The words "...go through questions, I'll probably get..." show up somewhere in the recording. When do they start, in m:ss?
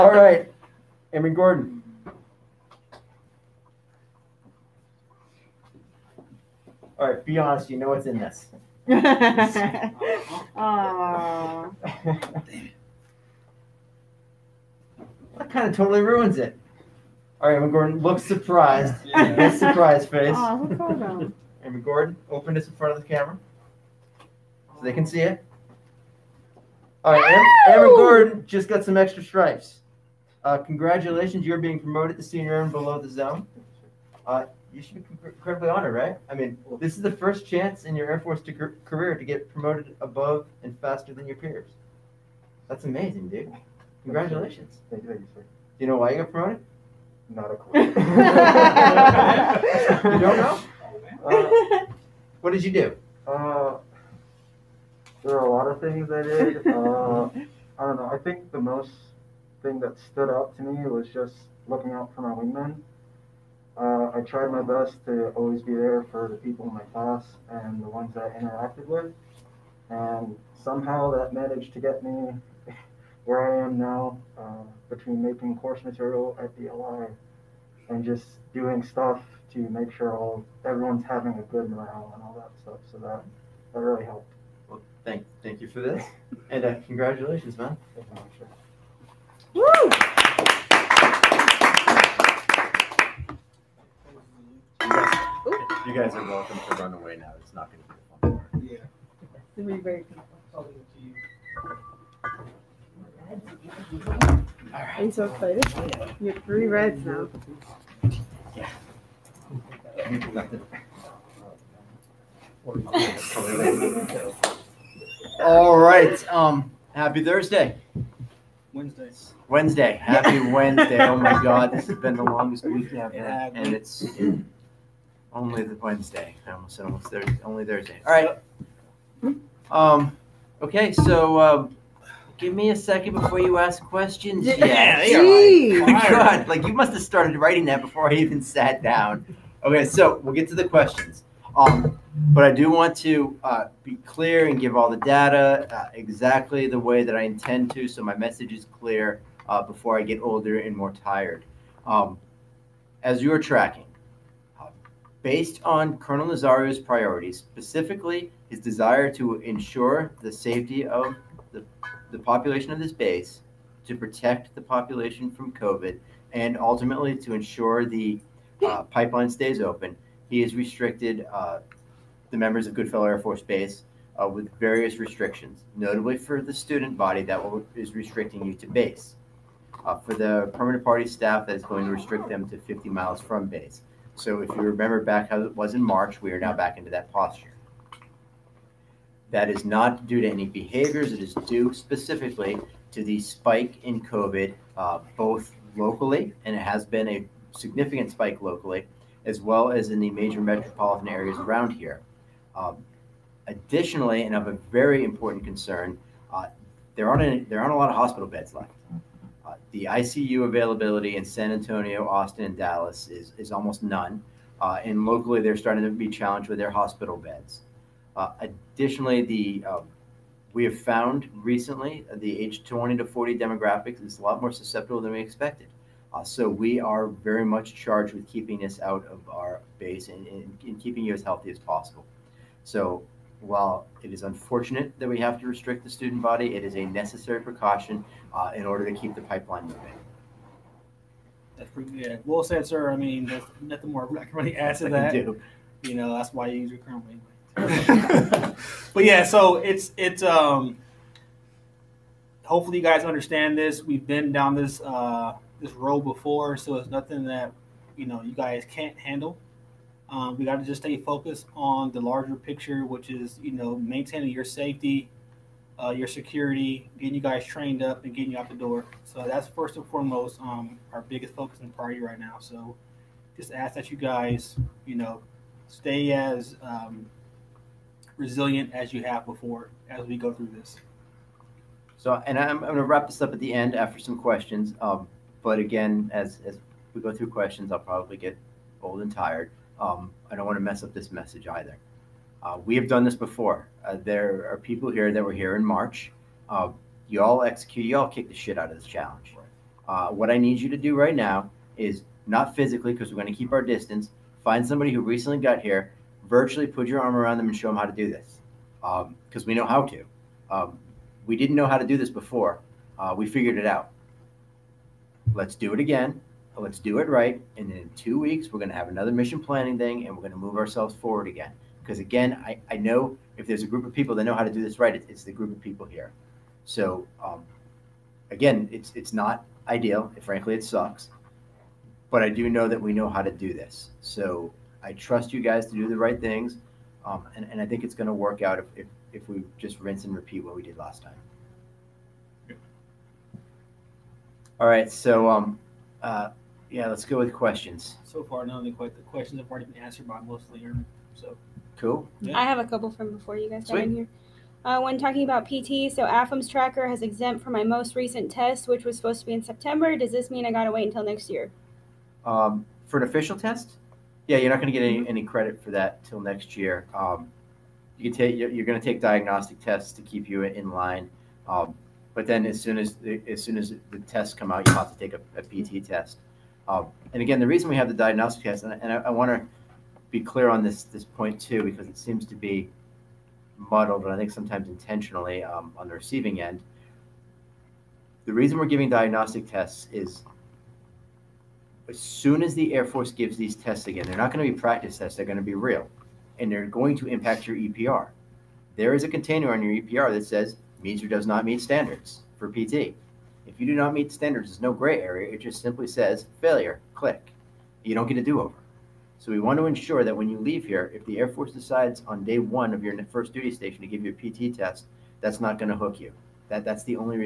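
4:47.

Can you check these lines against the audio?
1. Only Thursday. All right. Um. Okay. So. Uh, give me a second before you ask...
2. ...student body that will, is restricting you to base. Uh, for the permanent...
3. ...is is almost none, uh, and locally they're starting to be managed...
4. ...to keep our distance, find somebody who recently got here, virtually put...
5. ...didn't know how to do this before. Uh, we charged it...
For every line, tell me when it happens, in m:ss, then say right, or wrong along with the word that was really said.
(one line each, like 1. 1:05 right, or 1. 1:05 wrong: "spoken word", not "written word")
1. 2:07 right
2. 2:56 right
3. 3:33 wrong: "challenged", not "managed"
4. 5:03 right
5. 5:11 wrong: "figured", not "charged".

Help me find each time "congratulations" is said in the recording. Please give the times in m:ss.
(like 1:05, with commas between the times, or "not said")
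0:30, 0:44, 1:26.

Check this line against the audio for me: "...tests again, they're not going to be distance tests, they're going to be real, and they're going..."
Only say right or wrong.
wrong.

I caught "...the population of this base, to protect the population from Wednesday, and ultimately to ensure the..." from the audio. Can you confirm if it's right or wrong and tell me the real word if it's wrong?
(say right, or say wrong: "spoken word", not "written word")
wrong: "COVID", not "Wednesday".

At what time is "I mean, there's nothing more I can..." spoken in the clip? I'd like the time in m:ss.
4:02.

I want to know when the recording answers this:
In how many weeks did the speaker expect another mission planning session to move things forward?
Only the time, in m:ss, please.
5:17.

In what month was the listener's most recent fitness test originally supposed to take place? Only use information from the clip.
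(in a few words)
September.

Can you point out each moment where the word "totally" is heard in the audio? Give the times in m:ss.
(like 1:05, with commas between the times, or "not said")
0:15.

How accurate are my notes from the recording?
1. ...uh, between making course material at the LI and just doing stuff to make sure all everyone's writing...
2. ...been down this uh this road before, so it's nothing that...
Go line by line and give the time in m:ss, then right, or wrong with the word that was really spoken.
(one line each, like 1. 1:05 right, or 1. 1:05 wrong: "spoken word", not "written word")
1. 1:14 wrong: "having", not "writing"
2. 4:14 right.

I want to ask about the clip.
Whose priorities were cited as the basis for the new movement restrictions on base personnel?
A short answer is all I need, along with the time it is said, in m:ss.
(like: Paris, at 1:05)
Colonel Nazario, at 2:35.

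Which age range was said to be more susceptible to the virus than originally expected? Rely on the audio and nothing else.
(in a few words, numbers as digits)
20 to 40.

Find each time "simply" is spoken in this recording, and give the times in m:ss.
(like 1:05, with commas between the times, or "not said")
6:45.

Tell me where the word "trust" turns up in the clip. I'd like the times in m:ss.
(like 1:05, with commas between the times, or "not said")
5:34.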